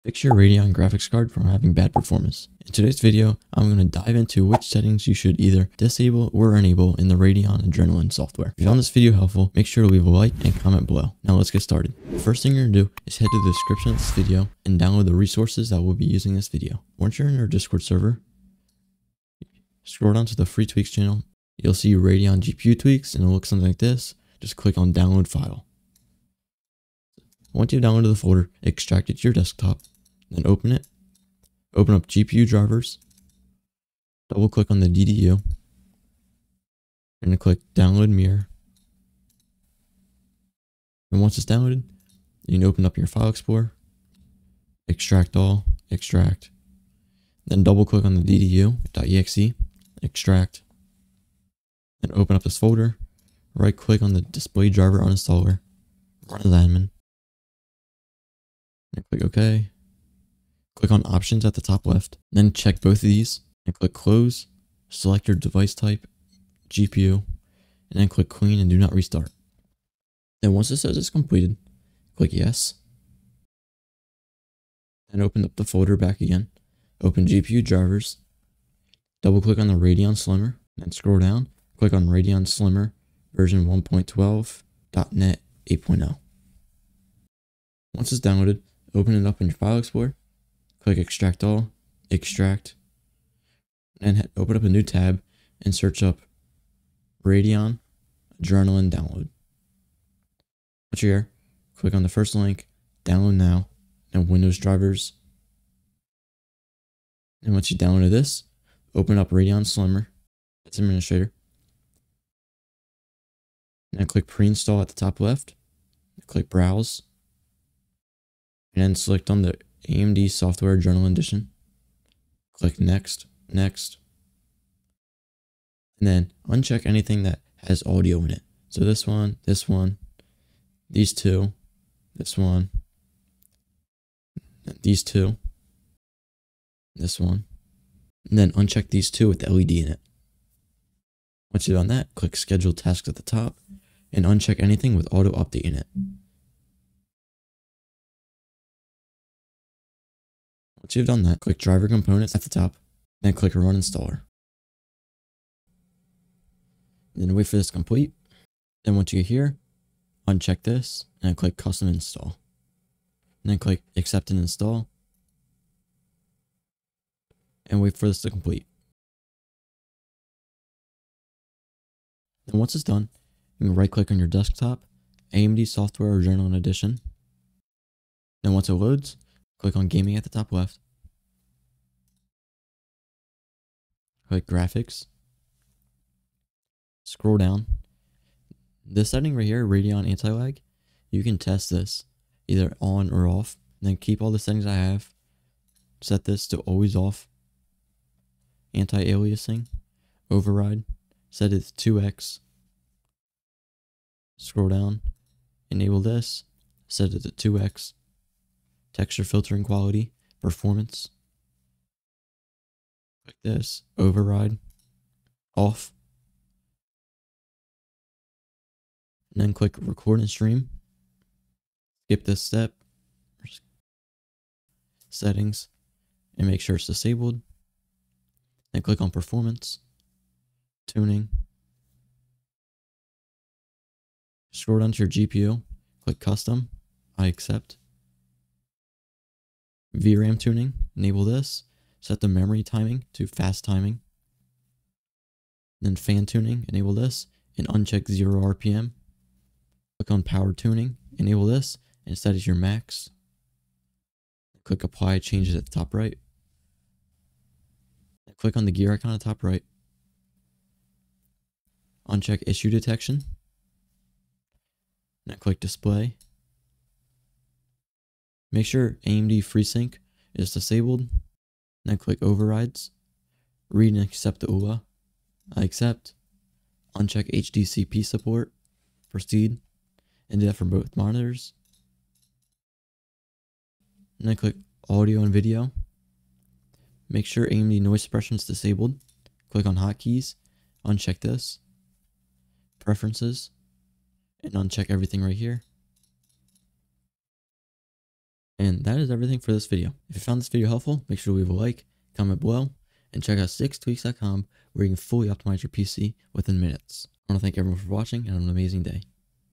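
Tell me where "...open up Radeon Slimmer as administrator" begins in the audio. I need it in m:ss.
1:48.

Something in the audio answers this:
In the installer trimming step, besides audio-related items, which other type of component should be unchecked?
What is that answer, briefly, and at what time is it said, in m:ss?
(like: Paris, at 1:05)
LED, at 2:19.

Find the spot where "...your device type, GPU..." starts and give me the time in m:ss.
1:05.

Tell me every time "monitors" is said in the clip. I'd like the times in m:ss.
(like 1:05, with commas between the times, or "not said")
4:40.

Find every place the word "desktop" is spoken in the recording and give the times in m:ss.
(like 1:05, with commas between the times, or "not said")
0:29, 2:54.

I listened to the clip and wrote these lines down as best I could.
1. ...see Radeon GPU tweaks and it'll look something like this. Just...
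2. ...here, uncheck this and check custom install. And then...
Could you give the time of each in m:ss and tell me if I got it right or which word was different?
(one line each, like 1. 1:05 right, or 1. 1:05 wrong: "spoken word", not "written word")
1. 0:21 right
2. 2:39 wrong: "click", not "check".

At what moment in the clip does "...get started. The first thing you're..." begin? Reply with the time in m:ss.
0:11.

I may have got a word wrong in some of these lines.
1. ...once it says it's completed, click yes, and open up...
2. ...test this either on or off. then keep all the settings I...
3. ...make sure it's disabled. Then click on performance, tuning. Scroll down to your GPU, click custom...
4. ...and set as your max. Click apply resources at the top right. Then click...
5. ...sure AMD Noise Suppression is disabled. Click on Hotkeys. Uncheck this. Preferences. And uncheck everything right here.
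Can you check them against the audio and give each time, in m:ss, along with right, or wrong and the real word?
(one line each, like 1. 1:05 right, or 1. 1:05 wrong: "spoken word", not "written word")
1. 1:10 right
2. 3:11 right
3. 3:46 right
4. 4:12 wrong: "changes", not "resources"
5. 4:47 right.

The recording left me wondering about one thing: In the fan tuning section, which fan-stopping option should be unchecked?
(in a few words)
0 RPM.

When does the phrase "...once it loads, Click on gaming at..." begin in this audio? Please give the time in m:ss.
2:58.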